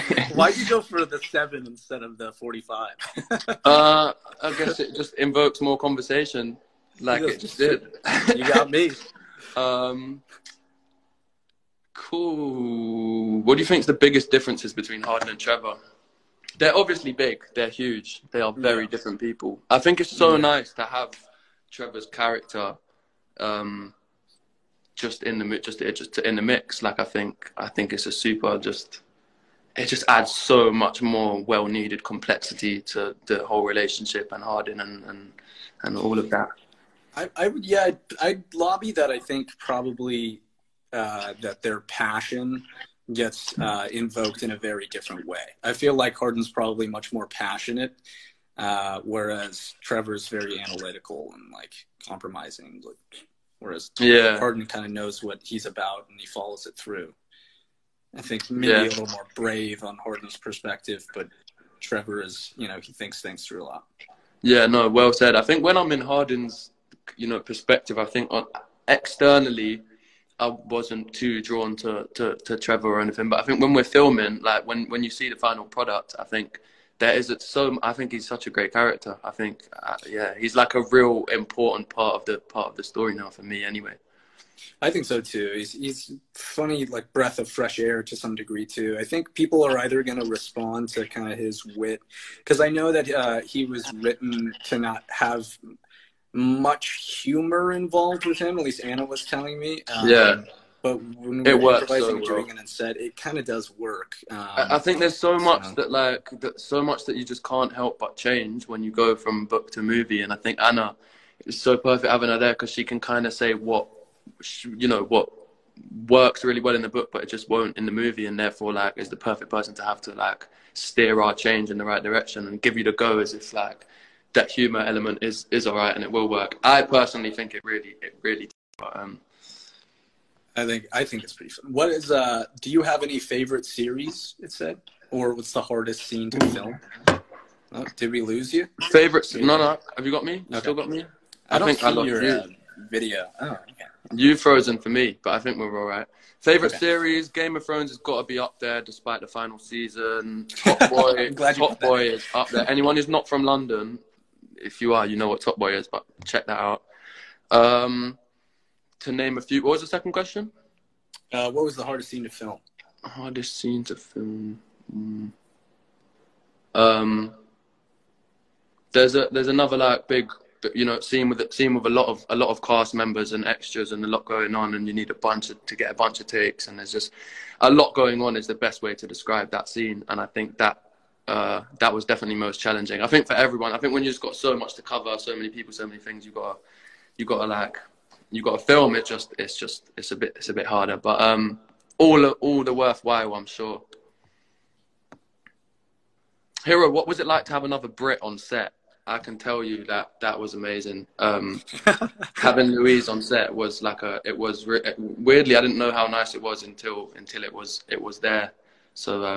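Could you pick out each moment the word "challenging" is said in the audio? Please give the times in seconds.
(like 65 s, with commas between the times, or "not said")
182 s.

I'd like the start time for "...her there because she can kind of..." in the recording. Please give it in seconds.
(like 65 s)
112 s.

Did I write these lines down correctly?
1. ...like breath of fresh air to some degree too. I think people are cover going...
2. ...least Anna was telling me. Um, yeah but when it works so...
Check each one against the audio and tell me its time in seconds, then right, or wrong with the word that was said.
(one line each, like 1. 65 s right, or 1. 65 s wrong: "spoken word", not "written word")
1. 86 s wrong: "either", not "cover"
2. 98 s right.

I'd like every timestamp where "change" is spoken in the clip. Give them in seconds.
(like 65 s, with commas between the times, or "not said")
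108 s, 121 s.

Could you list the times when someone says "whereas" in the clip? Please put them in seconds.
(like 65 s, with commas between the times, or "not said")
49 s, 53 s.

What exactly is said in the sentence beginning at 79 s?
I think uh, yeah, he's like a real important part of the part of the story now for me anyway.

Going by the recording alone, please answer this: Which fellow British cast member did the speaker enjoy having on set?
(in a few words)
Louise.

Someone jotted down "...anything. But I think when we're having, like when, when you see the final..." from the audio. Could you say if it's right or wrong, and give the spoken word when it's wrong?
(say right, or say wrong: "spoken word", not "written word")
wrong: "filming", not "having".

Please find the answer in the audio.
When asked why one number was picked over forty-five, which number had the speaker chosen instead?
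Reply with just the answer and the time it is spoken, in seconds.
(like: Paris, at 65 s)
7, at 1 s.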